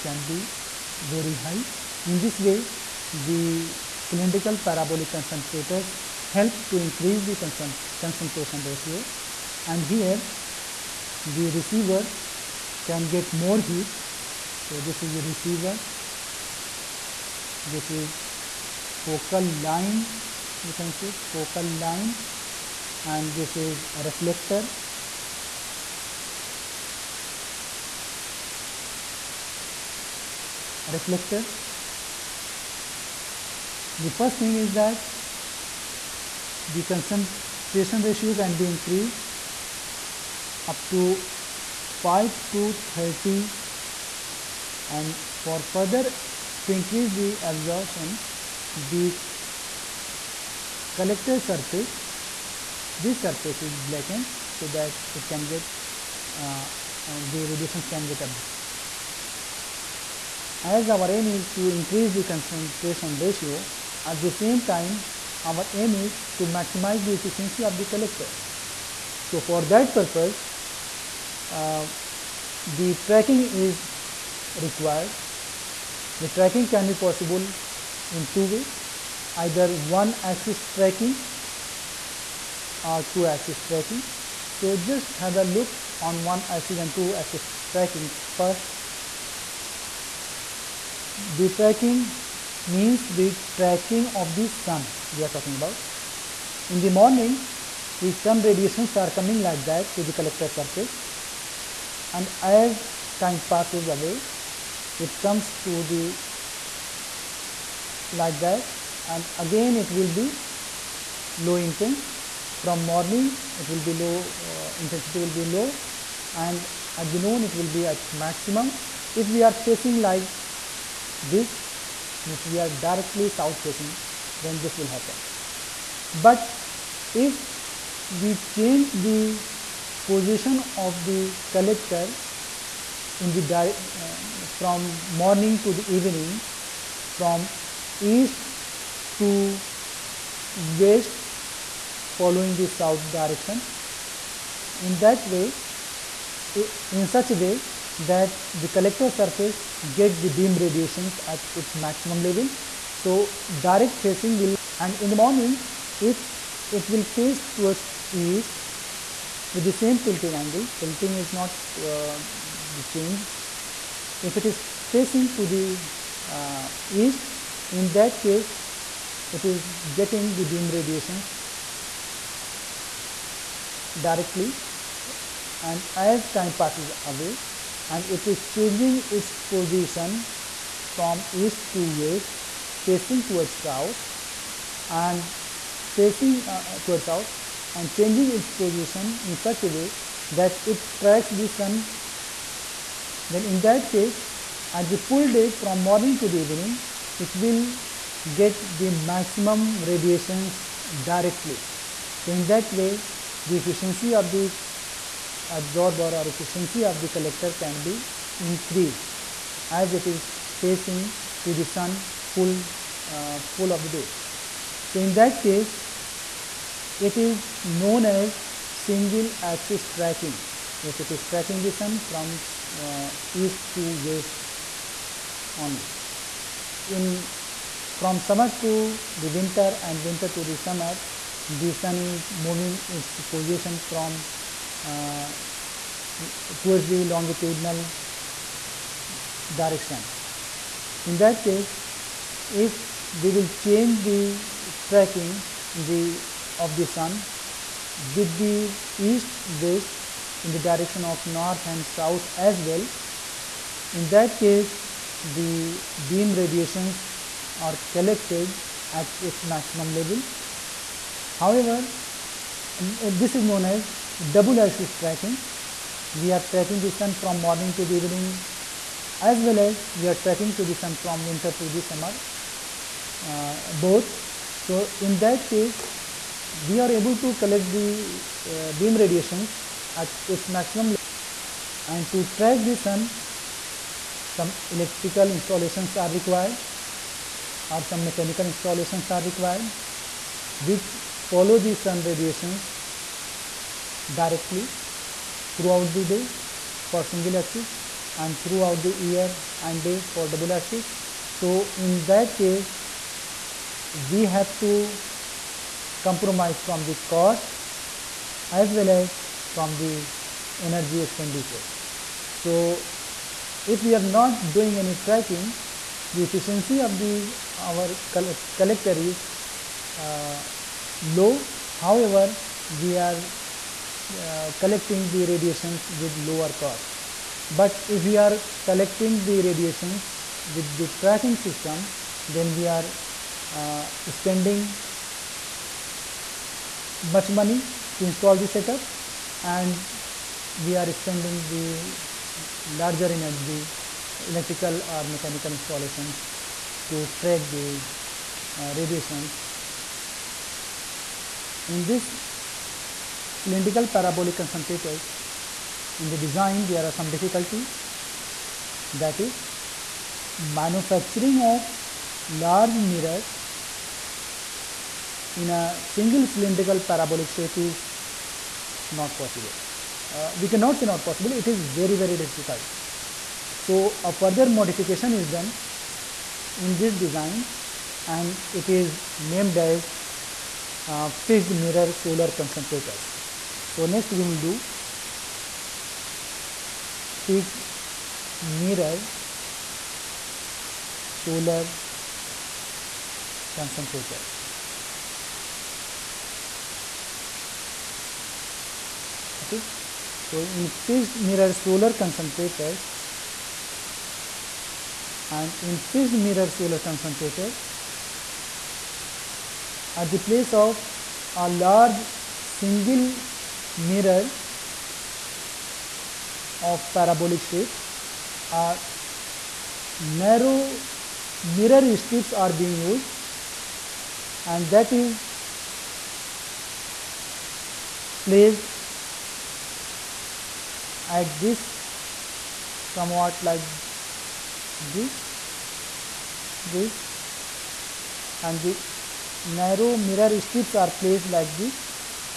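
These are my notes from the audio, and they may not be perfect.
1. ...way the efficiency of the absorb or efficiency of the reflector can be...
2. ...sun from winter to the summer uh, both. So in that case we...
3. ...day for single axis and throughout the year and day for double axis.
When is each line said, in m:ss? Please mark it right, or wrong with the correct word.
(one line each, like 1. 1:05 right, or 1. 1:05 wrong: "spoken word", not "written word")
1. 3:22 wrong: "collector", not "reflector"
2. 4:30 right
3. 4:56 right.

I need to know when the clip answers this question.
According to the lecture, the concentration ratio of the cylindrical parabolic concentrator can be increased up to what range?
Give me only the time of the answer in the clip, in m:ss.
0:41.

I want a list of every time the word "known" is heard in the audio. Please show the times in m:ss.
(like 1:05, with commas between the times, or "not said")
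3:37, 4:23.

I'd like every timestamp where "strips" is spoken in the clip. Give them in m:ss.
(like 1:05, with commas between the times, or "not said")
7:01, 7:20.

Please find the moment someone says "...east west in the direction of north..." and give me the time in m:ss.
4:08.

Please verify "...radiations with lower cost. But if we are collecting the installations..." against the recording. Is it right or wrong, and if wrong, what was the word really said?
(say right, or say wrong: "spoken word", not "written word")
wrong: "radiations", not "installations".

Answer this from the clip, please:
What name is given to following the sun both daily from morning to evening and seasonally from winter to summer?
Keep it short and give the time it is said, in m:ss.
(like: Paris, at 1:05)
Double axis tracking, at 4:24.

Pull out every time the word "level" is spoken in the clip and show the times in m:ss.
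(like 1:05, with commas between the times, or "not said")
2:32, 4:19, 4:40.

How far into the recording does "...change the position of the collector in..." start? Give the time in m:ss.
2:08.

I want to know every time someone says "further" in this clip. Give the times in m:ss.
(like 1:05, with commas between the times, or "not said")
0:45, 6:14.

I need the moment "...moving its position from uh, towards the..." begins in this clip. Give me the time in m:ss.
3:52.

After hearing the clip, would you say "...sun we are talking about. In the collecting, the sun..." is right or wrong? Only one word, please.
wrong.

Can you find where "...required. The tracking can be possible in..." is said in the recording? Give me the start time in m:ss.
1:14.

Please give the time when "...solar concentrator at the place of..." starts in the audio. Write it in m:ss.
6:46.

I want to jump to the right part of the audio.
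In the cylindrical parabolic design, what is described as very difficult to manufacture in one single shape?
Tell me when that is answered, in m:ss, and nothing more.
6:02.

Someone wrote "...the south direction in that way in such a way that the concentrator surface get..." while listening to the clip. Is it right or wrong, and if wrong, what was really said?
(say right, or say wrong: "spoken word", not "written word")
wrong: "collector", not "concentrator".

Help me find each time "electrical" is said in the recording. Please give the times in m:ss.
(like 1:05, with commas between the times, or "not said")
4:44, 5:44.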